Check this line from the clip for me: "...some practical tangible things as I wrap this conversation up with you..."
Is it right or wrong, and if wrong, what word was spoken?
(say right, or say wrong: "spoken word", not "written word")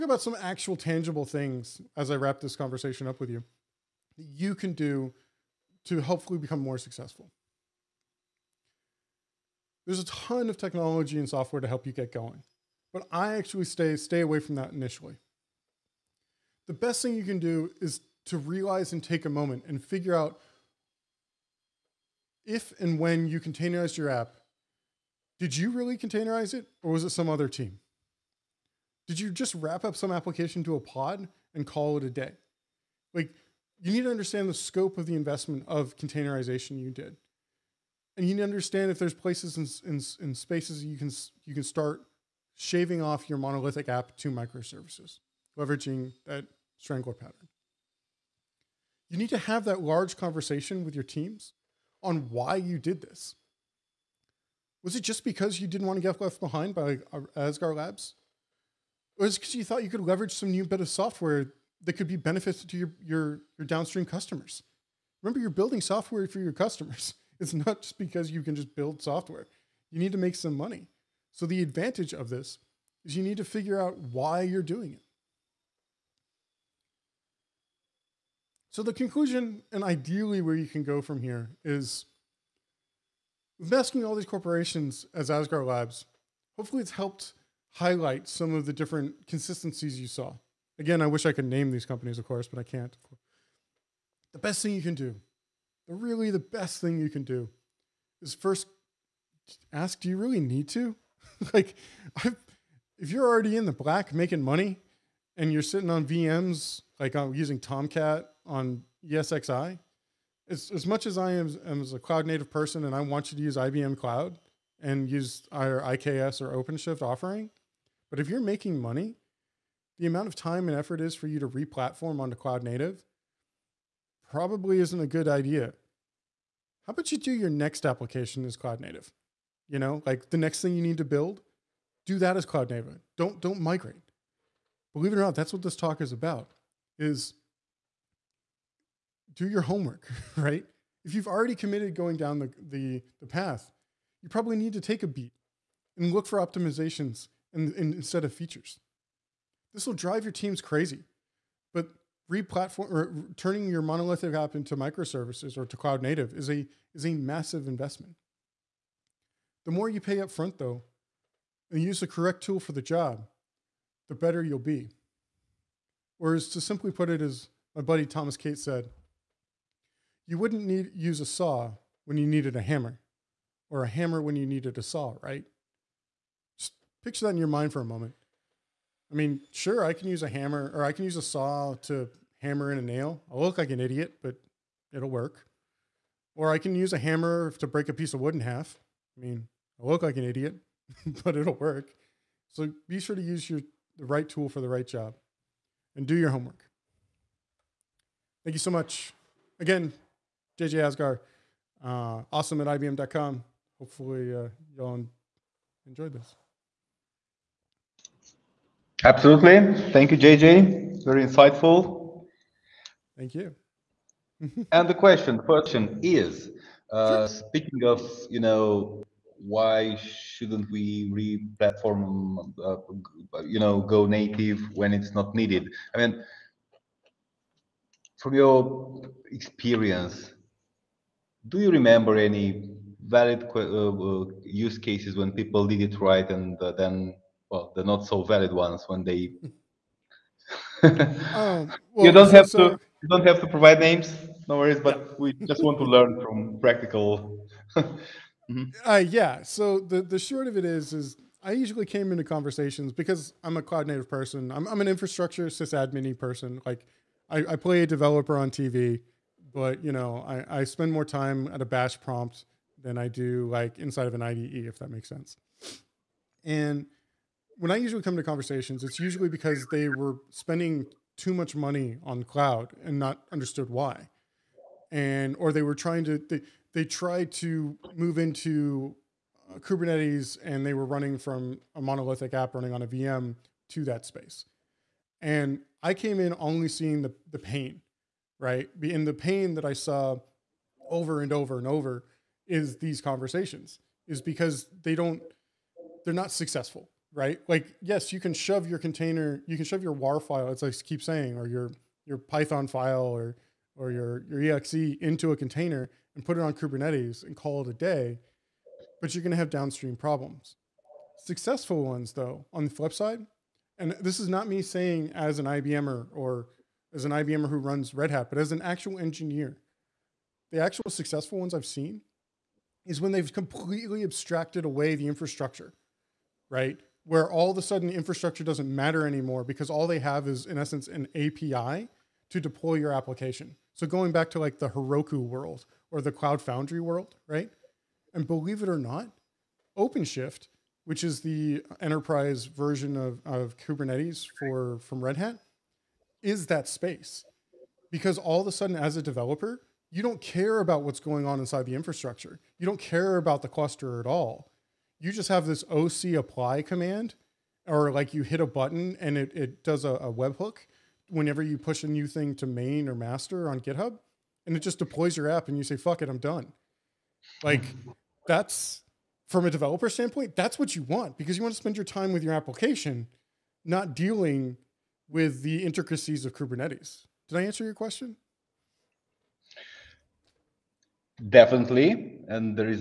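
wrong: "actual", not "practical".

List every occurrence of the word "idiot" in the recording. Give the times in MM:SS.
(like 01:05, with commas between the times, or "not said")
03:03, 03:10.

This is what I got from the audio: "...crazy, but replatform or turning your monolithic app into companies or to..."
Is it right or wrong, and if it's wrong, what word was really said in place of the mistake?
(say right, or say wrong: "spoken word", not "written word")
wrong: "microservices", not "companies".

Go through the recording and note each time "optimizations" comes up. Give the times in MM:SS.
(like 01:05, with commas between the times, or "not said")
02:26.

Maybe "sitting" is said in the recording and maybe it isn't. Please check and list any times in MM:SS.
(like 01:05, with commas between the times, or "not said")
01:45.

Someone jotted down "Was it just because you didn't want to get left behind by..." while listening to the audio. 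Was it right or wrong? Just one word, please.
right.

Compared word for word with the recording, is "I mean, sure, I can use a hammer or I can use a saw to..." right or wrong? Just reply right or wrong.
right.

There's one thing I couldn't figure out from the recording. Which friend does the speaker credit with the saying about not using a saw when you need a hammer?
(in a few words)
Thomas Kate.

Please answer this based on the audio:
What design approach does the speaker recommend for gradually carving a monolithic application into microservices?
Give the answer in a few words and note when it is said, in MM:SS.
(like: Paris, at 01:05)
Strangler pattern, at 00:46.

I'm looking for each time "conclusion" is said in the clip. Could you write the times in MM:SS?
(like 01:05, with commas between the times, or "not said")
01:18.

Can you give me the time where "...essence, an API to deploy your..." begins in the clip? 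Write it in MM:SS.
05:30.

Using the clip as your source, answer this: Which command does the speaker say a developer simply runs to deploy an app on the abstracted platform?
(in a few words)
OC apply.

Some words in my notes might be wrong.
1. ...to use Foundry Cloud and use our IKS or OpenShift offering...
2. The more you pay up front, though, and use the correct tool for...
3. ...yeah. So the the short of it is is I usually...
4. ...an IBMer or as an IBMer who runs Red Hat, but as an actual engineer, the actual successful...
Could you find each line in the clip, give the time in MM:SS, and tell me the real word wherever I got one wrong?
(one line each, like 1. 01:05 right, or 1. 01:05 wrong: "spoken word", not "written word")
1. 01:53 wrong: "IBM", not "Foundry"
2. 02:39 right
3. 04:08 right
4. 05:15 right.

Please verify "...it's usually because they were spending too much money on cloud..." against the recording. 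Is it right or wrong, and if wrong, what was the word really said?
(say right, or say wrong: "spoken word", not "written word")
right.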